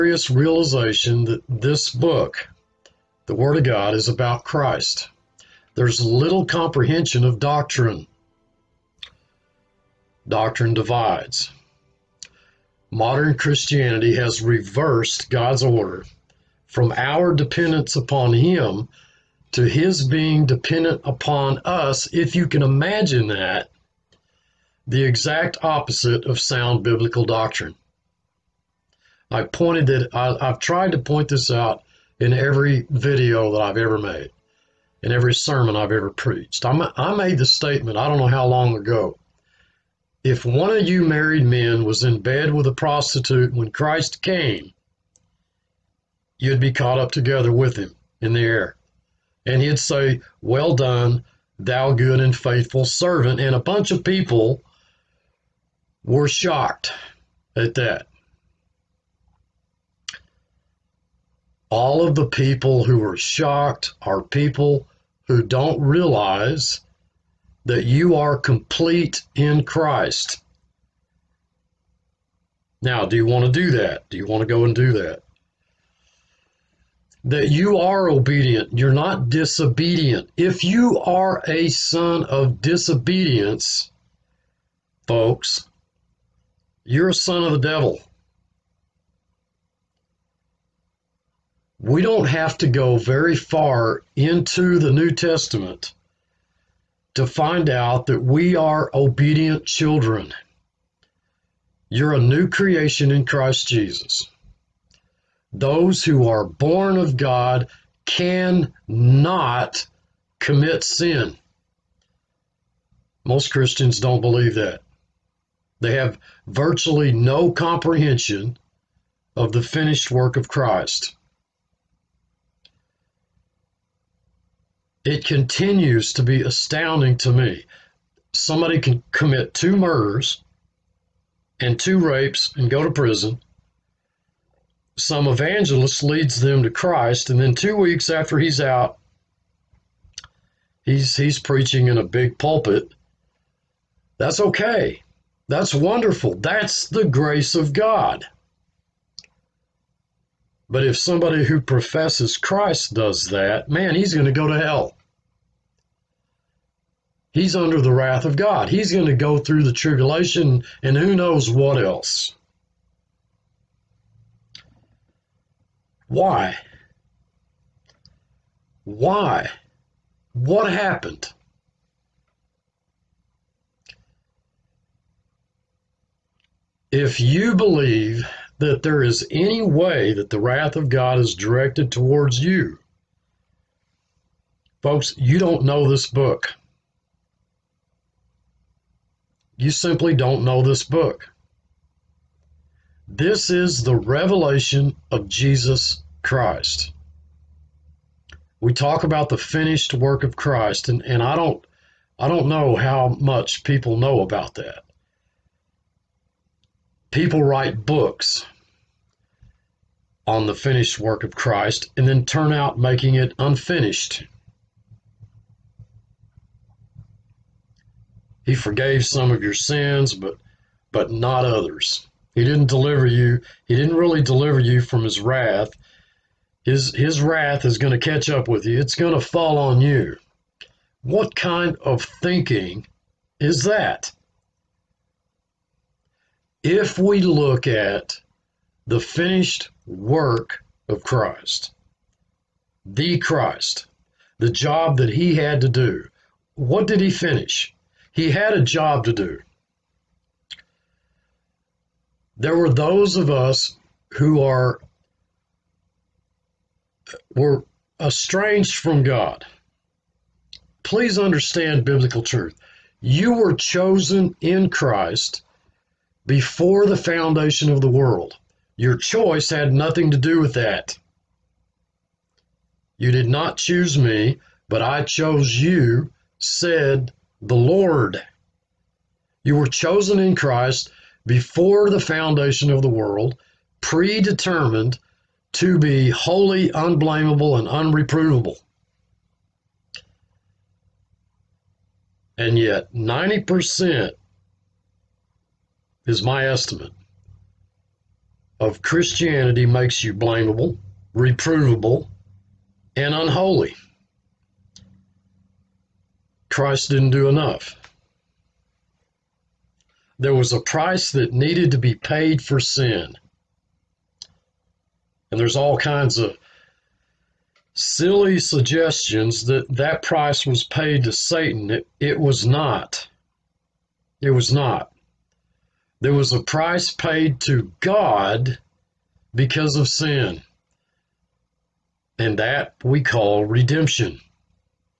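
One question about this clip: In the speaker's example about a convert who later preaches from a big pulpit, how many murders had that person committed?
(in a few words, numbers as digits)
2.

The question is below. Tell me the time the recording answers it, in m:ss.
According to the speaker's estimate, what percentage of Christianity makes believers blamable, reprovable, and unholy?
4:52.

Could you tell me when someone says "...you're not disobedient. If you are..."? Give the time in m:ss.
1:18.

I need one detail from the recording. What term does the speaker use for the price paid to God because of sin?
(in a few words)
redemption.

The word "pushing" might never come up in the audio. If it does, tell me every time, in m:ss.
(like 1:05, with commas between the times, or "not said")
not said.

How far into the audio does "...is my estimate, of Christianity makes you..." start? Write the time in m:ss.
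4:56.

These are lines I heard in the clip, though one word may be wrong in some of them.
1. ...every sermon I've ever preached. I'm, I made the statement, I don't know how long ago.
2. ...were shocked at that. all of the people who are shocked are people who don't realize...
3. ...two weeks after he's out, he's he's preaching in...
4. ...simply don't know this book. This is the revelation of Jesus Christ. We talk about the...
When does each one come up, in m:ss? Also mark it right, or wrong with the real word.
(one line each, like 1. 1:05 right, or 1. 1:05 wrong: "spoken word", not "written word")
1. 0:35 right
2. 0:56 right
3. 2:17 right
4. 3:09 right.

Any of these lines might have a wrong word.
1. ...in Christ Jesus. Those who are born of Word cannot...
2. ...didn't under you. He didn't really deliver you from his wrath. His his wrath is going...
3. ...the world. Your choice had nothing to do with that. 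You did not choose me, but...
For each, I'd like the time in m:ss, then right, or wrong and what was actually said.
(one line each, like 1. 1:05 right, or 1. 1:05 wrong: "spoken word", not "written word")
1. 1:43 wrong: "God", not "Word"
2. 3:42 wrong: "deliver", not "under"
3. 4:27 right.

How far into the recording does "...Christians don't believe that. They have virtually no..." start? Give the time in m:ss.
1:53.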